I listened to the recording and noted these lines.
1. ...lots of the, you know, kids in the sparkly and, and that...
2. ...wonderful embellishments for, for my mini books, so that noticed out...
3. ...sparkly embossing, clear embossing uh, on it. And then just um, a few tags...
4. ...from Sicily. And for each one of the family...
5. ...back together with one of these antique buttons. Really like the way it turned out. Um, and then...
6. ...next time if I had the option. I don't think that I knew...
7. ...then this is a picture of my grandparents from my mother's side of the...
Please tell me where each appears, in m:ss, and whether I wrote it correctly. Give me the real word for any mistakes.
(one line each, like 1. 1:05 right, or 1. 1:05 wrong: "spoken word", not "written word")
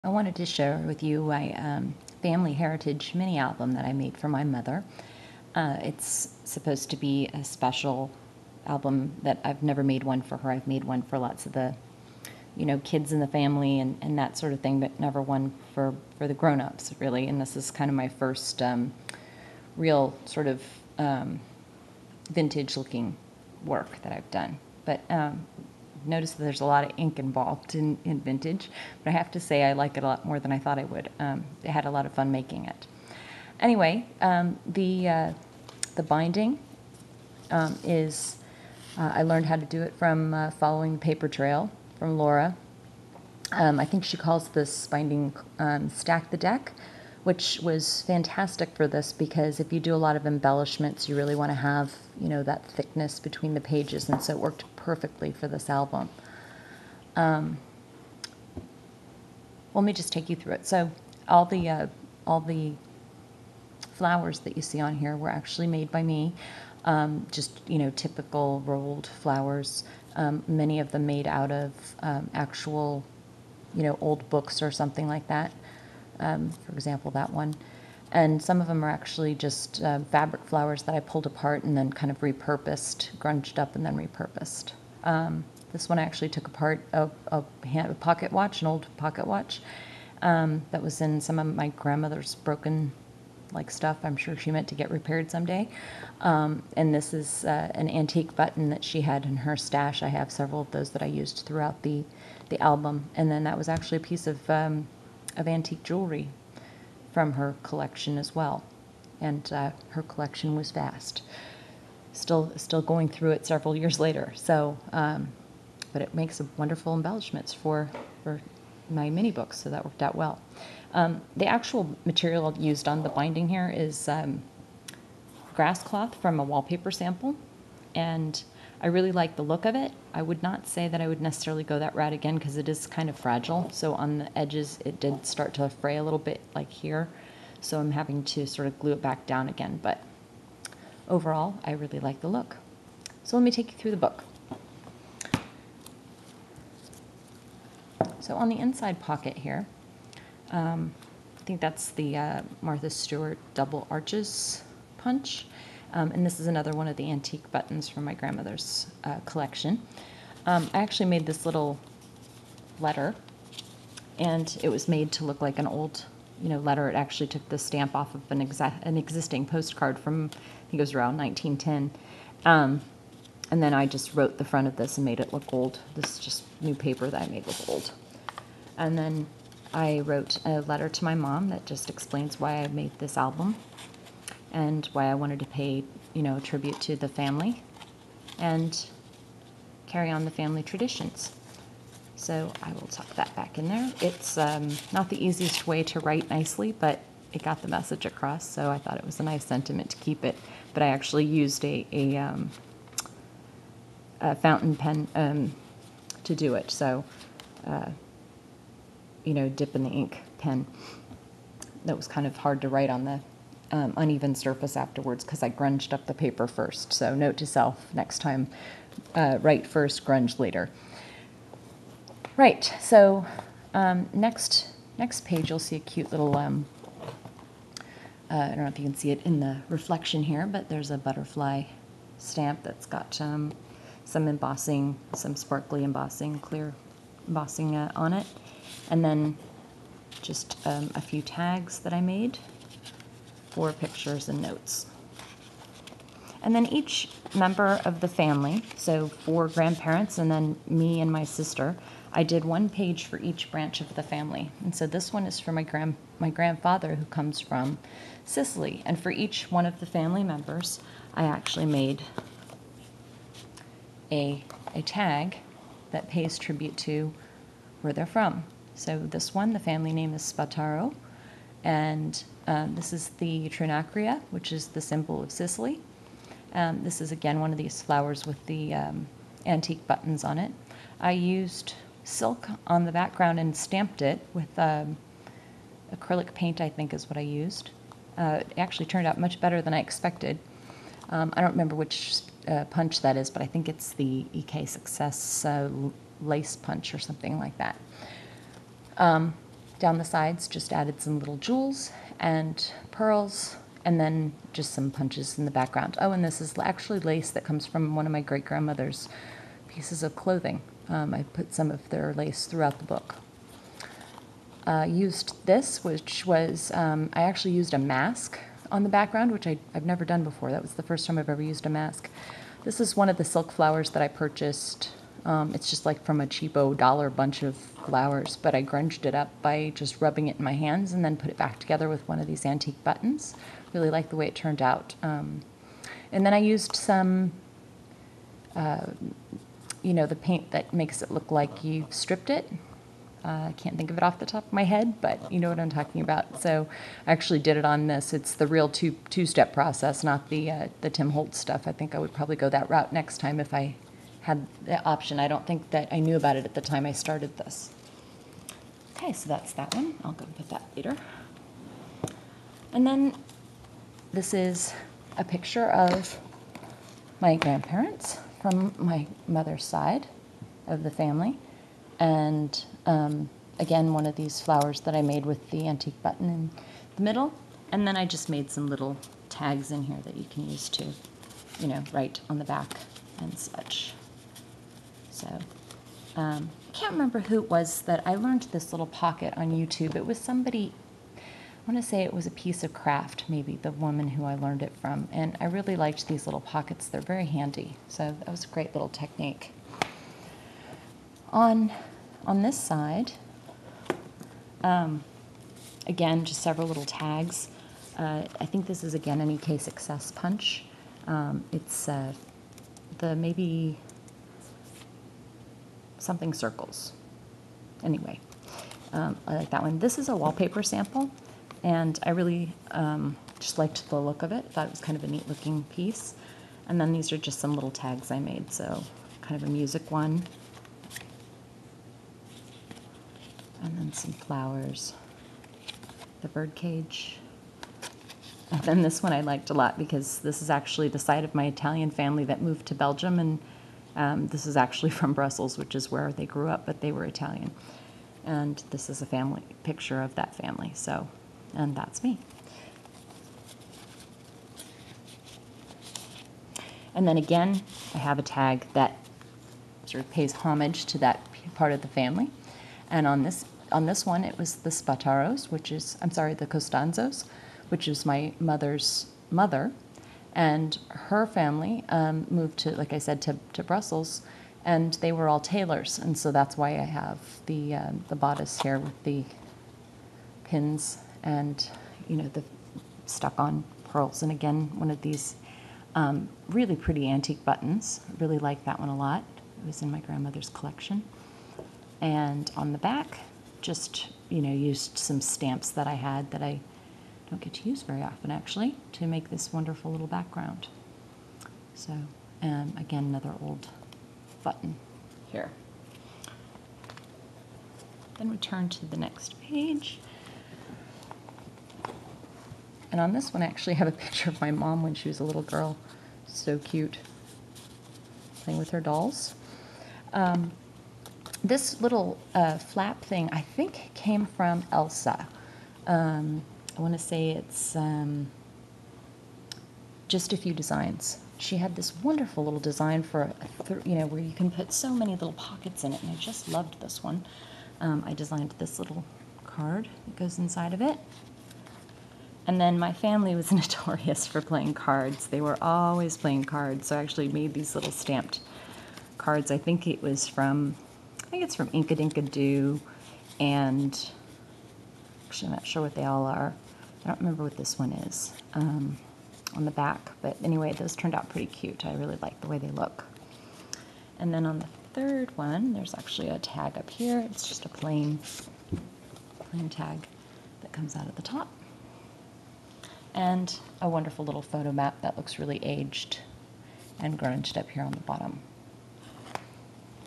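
1. 0:11 wrong: "family", not "sparkly"
2. 1:56 wrong: "worked", not "noticed"
3. 3:55 right
4. 4:17 right
5. 5:31 right
6. 5:52 right
7. 6:02 right.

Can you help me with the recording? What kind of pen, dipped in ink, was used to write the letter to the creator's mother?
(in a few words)
Fountain pen.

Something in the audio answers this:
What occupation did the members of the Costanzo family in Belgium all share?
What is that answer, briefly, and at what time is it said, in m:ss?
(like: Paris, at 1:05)
Tailors, at 7:55.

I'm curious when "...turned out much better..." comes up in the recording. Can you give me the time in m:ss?
4:48.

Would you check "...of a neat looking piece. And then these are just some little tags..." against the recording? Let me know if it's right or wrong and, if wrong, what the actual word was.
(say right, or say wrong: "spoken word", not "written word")
right.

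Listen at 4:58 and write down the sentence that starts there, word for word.
Um, down the sides, just added some little jewels and pearls, and then just some punches in the background.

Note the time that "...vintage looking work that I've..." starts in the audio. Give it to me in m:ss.
0:22.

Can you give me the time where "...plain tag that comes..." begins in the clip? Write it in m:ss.
9:29.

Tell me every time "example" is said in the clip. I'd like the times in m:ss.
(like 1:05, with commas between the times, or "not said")
1:16.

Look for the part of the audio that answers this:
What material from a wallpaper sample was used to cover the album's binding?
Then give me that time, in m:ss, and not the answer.
2:05.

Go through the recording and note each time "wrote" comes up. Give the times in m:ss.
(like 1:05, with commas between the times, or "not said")
2:54, 3:00.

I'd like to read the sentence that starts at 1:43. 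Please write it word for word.
And then that was actually a piece of um, of antique jewelry from her collection as well.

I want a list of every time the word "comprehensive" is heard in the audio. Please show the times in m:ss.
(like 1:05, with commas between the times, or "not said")
not said.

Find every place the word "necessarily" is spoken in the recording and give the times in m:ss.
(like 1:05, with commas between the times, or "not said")
2:11.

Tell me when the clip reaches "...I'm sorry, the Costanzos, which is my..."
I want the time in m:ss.
7:46.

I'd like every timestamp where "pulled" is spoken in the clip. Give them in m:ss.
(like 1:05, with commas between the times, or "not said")
1:20.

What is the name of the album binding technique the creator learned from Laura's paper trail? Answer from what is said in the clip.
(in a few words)
Stack the Deck.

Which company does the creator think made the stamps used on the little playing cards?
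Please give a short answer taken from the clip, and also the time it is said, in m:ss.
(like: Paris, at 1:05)
Inkadinkado, at 9:11.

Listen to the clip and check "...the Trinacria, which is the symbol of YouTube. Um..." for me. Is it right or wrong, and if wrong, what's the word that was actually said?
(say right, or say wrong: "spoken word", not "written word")
wrong: "Sicily", not "YouTube".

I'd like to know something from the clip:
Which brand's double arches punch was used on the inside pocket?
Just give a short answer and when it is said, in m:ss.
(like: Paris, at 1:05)
Martha Stewart, at 2:32.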